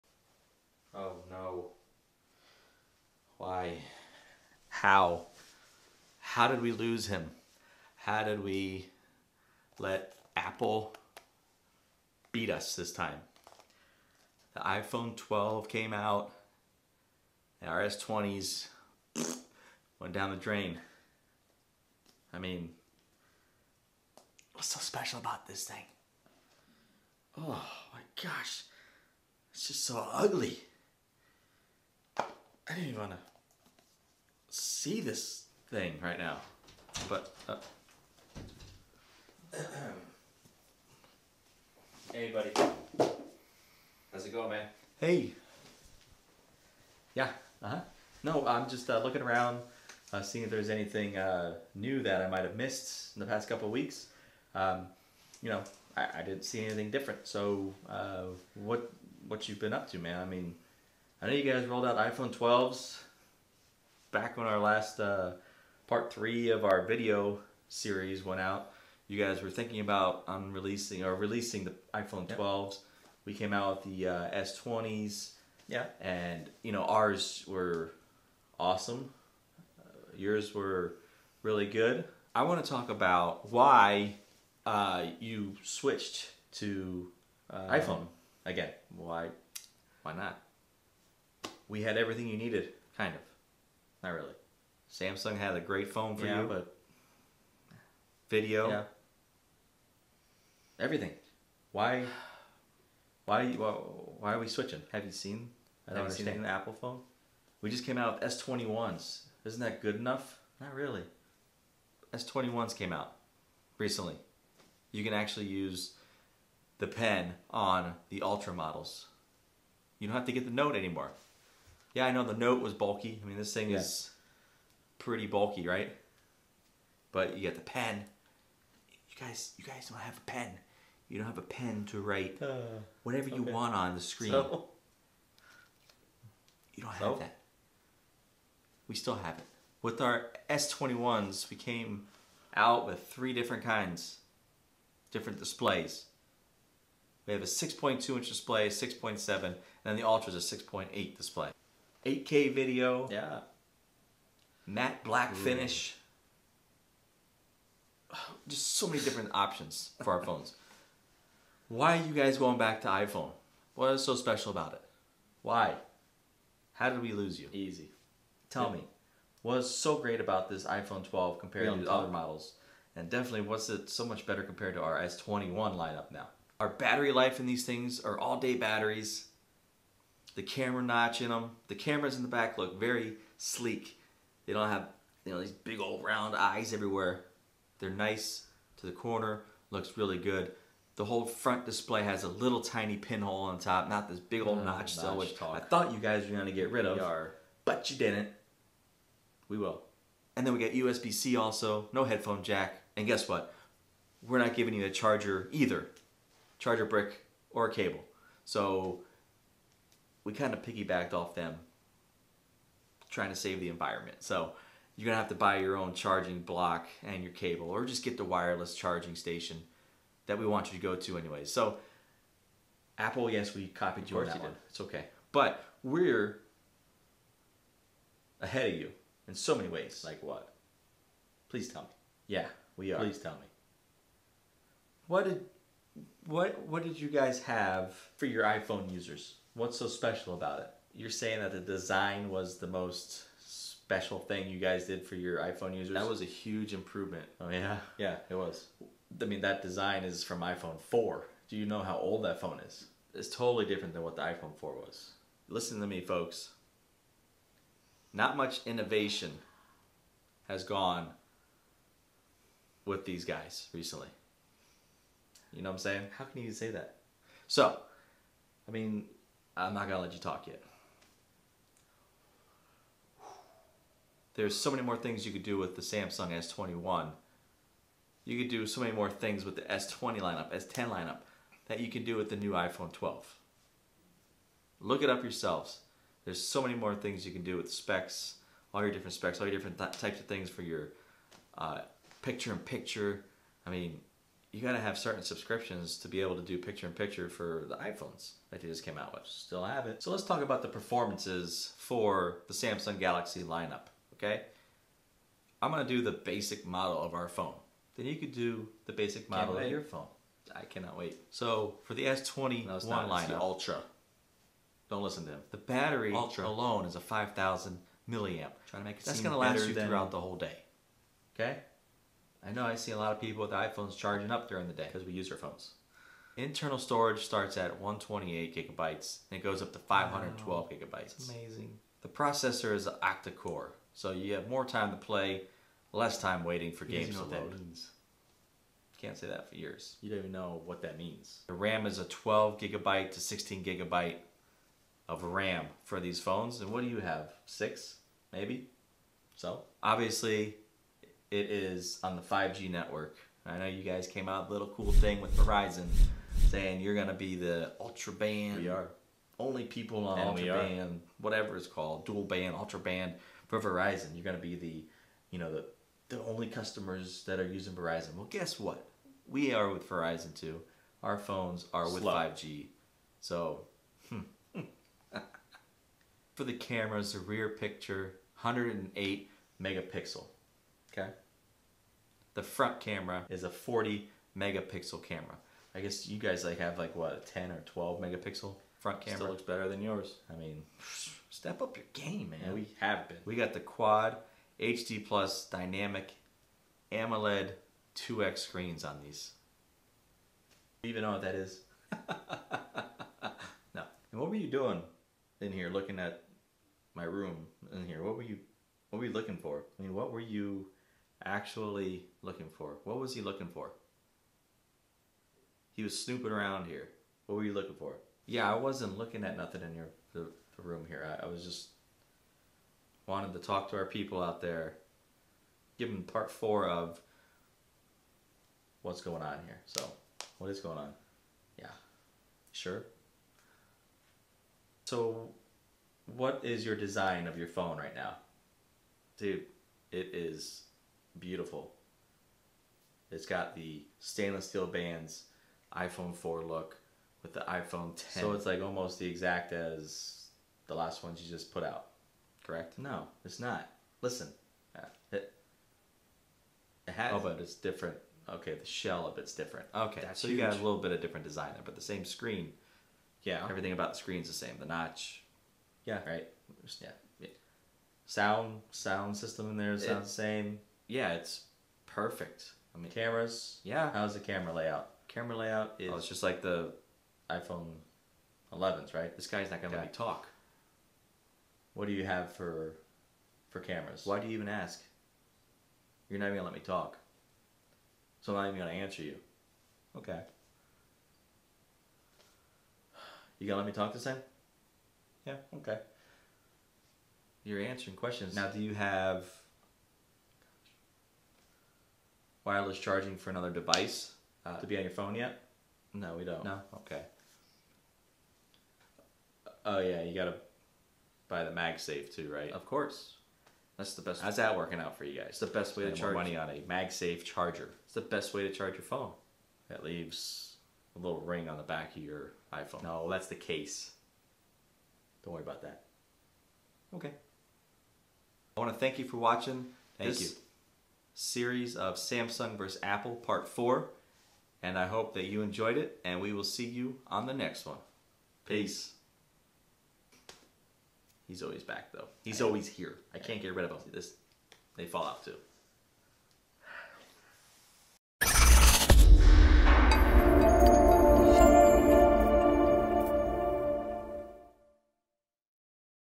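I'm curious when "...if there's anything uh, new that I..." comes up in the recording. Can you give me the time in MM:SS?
00:50.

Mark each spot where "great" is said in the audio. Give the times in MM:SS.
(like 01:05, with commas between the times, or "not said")
01:35, 02:49.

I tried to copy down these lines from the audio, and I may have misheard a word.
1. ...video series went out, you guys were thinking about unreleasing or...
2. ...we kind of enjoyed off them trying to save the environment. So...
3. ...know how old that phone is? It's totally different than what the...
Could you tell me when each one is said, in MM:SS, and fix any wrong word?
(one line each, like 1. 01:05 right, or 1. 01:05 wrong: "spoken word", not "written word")
1. 01:06 right
2. 03:30 wrong: "piggybacked", not "enjoyed"
3. 04:11 right.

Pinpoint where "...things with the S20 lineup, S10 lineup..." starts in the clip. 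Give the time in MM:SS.
04:39.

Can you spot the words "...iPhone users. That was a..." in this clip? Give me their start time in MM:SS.
04:05.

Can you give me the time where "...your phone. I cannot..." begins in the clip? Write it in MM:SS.
05:09.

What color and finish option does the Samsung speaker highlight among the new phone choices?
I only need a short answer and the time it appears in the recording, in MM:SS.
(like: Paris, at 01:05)
Matte black, at 02:34.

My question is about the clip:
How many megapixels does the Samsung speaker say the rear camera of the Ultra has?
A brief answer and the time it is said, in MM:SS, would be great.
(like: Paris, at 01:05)
108, at 06:18.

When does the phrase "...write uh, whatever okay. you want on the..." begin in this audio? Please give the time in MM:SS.
02:11.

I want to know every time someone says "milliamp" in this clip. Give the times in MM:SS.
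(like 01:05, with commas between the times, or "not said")
05:18.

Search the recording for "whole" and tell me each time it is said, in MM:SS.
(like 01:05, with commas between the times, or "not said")
03:11, 05:20.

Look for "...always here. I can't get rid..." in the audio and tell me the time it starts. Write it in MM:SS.
09:02.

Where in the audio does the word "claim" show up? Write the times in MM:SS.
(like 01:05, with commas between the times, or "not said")
not said.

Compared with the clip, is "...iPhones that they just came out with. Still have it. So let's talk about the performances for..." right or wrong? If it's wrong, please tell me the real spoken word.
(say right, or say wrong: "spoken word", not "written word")
right.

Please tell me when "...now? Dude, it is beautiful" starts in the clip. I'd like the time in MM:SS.
07:17.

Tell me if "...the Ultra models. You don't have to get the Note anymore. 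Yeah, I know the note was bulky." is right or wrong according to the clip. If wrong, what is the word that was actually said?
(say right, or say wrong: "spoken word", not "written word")
right.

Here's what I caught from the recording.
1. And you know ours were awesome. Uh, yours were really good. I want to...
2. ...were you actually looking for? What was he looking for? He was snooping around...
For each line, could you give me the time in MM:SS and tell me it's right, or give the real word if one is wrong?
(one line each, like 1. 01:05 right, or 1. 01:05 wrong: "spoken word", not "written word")
1. 01:16 right
2. 06:50 right.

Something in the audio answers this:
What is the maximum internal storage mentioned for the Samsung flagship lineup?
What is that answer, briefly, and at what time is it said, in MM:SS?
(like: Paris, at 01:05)
512 gigabytes, at 05:29.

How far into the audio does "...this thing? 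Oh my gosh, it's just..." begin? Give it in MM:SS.
00:25.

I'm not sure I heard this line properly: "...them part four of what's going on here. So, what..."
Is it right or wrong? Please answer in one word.
right.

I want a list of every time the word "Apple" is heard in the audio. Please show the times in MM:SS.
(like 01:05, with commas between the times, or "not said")
00:10, 01:46, 03:42, 08:52.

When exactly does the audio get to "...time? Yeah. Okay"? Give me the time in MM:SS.
08:14.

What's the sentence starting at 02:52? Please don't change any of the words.
And definitely, what's it so much better compared to our S21 lineup now?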